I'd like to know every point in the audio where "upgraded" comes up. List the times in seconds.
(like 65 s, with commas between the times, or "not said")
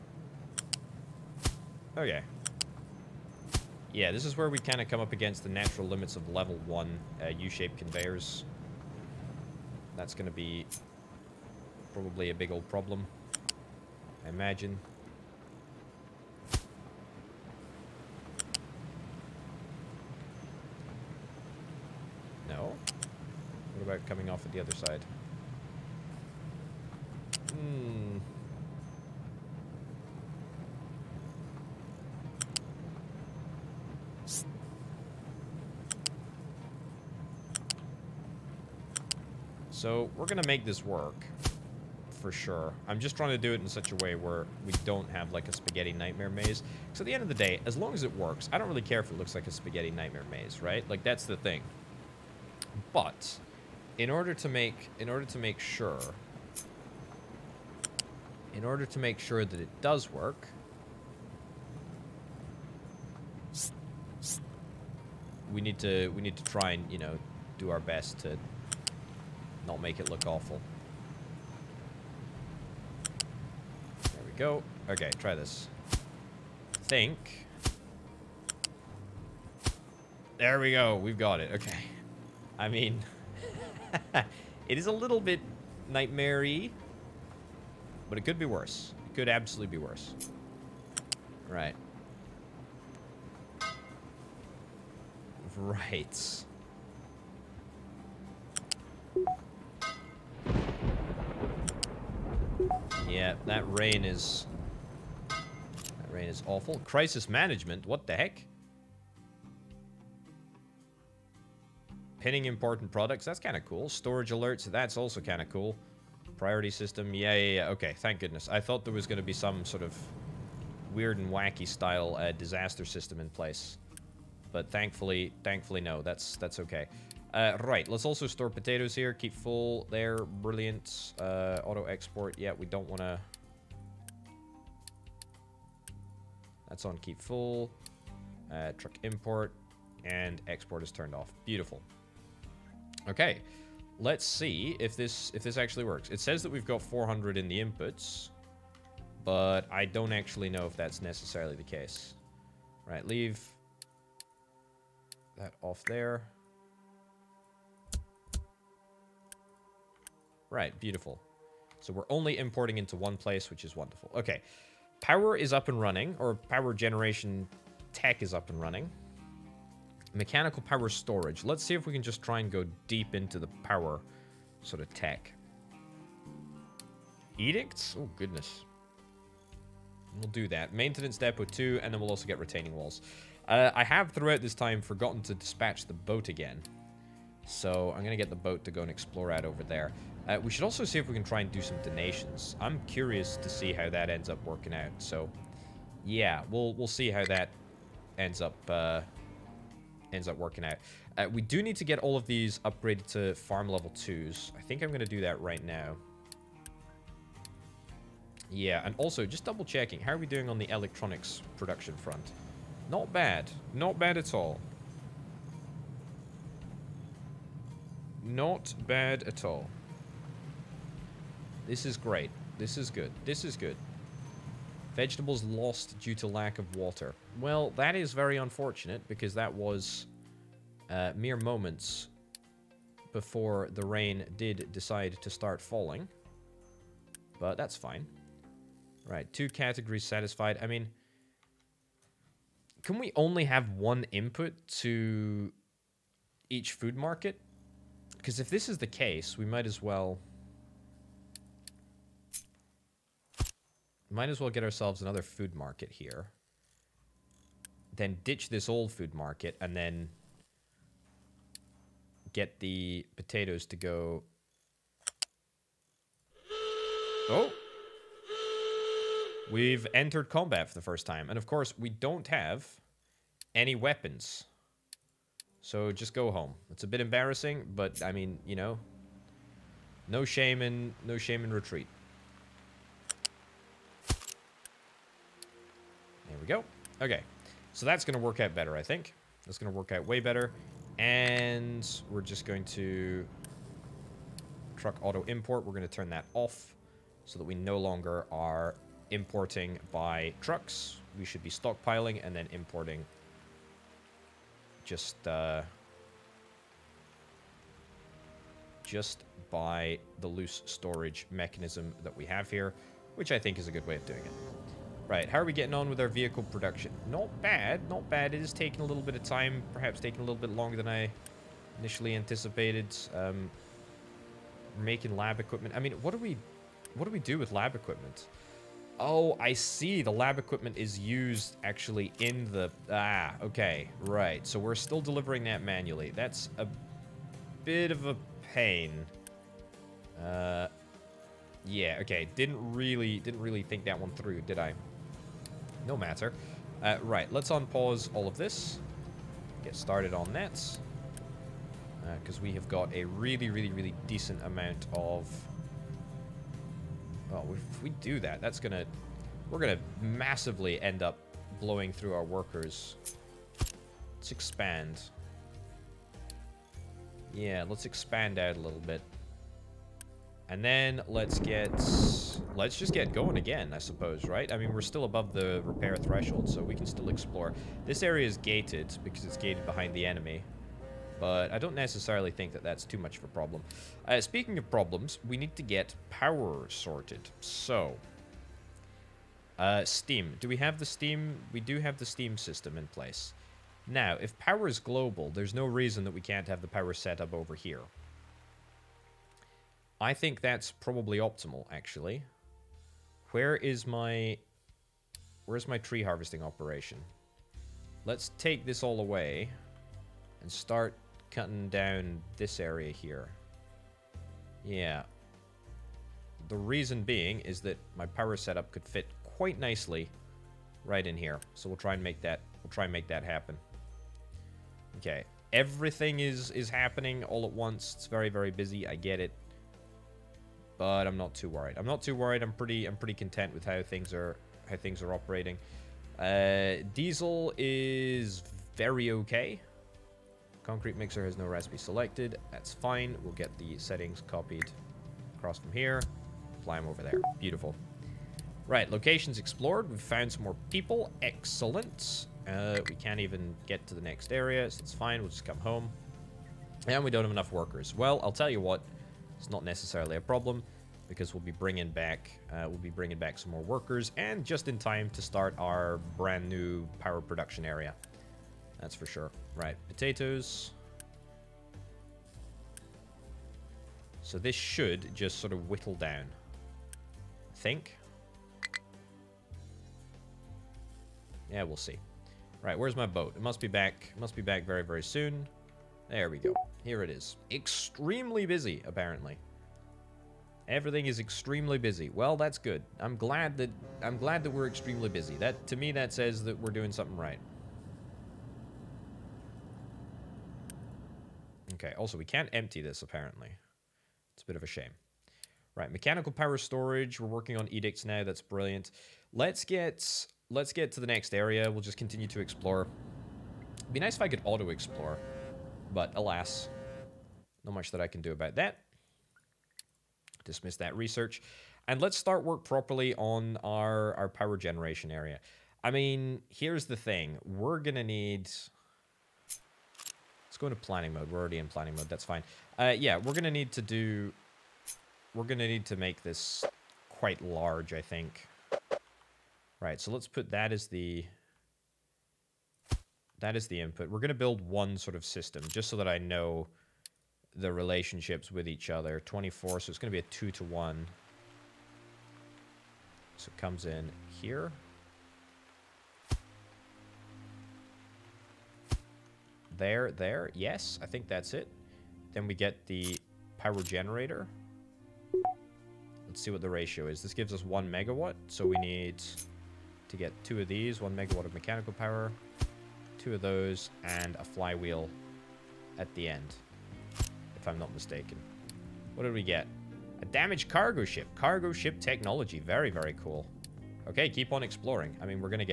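202 s.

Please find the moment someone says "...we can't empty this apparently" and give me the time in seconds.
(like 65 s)
502 s.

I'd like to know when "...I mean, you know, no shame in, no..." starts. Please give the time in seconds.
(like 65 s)
278 s.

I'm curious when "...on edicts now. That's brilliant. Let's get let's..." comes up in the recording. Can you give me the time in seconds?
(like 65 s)
507 s.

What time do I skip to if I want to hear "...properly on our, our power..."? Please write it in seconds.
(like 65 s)
522 s.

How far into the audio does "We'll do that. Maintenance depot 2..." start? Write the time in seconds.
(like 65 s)
180 s.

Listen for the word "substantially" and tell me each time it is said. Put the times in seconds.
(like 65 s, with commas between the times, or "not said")
not said.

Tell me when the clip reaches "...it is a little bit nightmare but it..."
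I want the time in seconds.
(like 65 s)
84 s.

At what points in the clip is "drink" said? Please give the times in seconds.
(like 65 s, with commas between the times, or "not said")
not said.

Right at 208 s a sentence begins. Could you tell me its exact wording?
Yeah, and also just double checking.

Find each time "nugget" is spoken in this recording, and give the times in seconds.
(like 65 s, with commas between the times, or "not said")
not said.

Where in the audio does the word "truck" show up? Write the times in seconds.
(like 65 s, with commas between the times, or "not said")
138 s, 294 s, 300 s.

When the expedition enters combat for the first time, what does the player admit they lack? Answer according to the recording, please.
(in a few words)
Weapons.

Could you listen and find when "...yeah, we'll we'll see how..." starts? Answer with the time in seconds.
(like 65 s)
196 s.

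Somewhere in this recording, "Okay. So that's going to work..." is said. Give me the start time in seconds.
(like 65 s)
287 s.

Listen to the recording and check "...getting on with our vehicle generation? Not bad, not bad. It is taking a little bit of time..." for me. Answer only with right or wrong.
wrong.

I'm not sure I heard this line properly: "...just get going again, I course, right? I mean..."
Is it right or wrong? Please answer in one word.
wrong.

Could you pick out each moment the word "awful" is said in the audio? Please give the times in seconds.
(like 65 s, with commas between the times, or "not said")
70 s, 106 s.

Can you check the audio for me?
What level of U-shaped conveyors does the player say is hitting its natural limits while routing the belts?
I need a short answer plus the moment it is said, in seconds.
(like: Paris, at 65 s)
Level 1, at 6 s.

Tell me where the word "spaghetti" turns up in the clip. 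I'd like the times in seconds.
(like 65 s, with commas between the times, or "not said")
45 s, 49 s.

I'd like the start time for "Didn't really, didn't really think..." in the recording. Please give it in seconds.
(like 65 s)
342 s.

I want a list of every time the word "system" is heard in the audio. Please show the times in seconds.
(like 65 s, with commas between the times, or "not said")
116 s, 122 s, 392 s, 545 s.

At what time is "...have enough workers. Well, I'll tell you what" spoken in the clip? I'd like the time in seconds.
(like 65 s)
457 s.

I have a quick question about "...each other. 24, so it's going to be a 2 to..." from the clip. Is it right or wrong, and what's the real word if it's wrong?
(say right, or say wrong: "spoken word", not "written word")
right.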